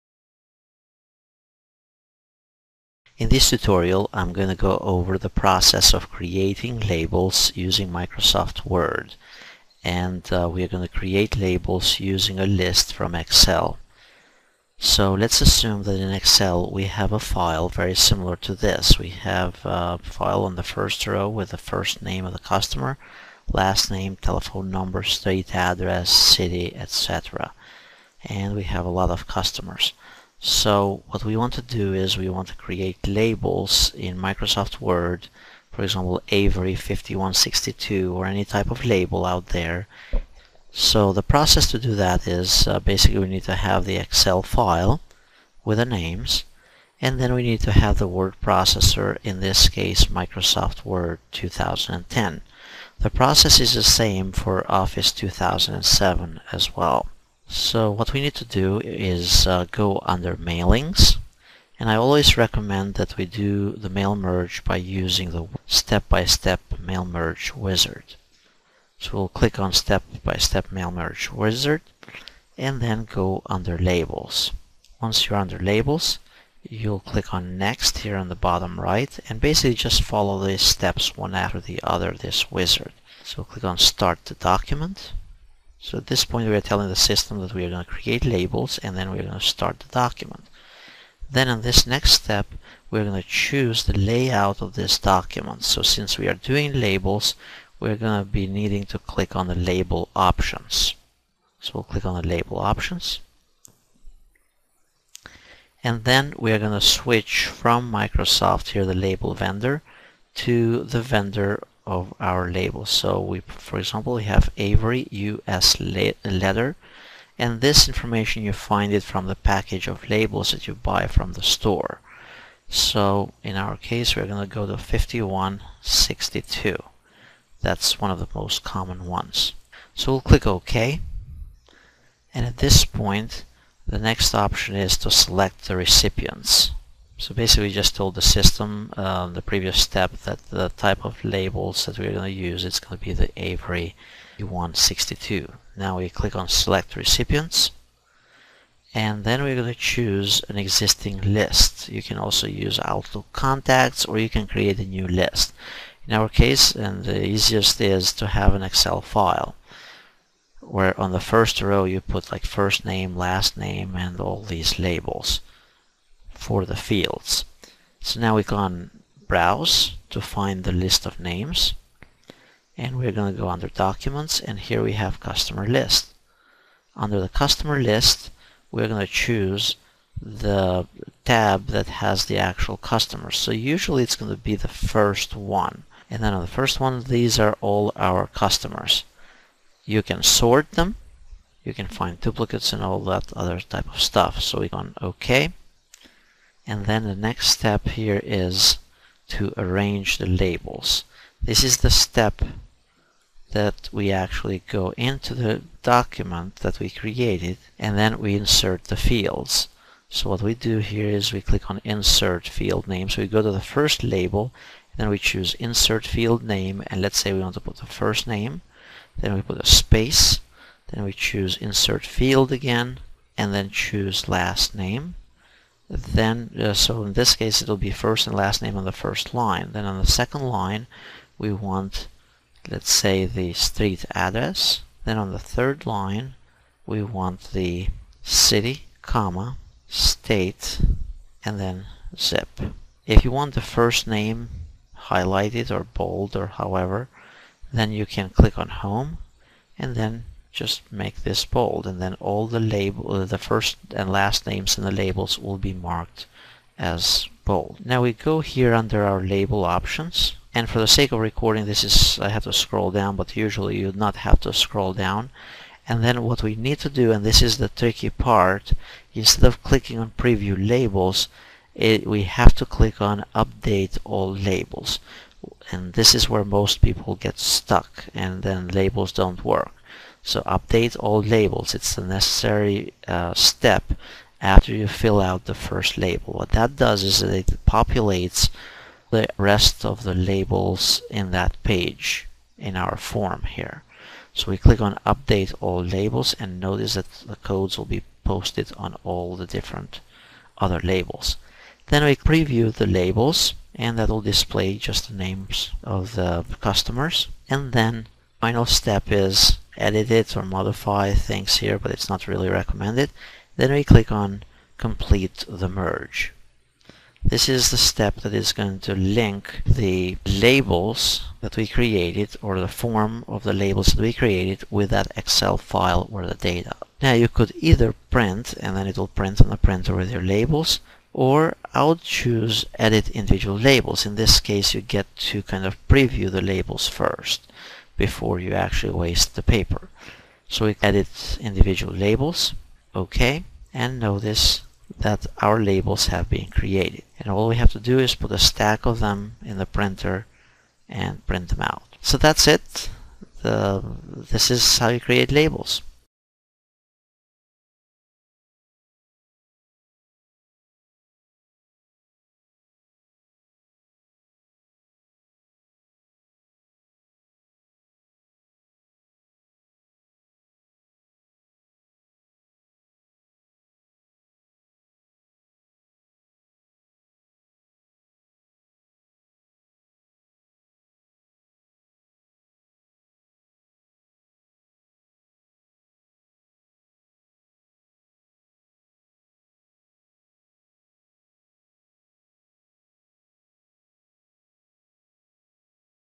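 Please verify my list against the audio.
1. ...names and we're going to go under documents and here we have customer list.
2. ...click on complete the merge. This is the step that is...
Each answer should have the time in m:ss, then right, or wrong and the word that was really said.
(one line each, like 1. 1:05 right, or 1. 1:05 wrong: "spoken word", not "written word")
1. 2:51 right
2. 5:13 right.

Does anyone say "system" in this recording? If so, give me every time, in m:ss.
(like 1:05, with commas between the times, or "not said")
1:26, 2:18.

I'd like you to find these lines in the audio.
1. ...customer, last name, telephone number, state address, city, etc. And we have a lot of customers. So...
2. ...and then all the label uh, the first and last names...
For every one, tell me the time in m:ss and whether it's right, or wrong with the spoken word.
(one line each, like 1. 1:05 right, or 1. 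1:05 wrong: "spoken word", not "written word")
1. 0:22 right
2. 4:11 right.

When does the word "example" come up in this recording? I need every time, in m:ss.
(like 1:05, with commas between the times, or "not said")
0:35, 1:53.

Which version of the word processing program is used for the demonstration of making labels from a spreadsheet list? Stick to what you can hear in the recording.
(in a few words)
Microsoft Word 2010.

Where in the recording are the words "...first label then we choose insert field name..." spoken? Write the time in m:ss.
3:33.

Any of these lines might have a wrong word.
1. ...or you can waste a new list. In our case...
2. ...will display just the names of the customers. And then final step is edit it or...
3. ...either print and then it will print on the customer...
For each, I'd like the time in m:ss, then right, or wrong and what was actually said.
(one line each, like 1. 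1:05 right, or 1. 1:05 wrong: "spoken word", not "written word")
1. 2:34 wrong: "create", not "waste"
2. 5:04 right
3. 5:27 wrong: "printer", not "customer".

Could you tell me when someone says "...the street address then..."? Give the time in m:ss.
3:53.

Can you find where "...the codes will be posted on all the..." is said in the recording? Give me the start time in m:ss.
4:57.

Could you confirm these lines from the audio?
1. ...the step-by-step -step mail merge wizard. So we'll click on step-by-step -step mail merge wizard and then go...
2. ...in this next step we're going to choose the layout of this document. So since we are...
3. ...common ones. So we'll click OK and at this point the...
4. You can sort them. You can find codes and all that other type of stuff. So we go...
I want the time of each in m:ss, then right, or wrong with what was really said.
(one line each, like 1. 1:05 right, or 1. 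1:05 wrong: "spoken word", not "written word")
1. 1:05 right
2. 1:31 right
3. 2:08 right
4. 3:09 wrong: "duplicates", not "codes".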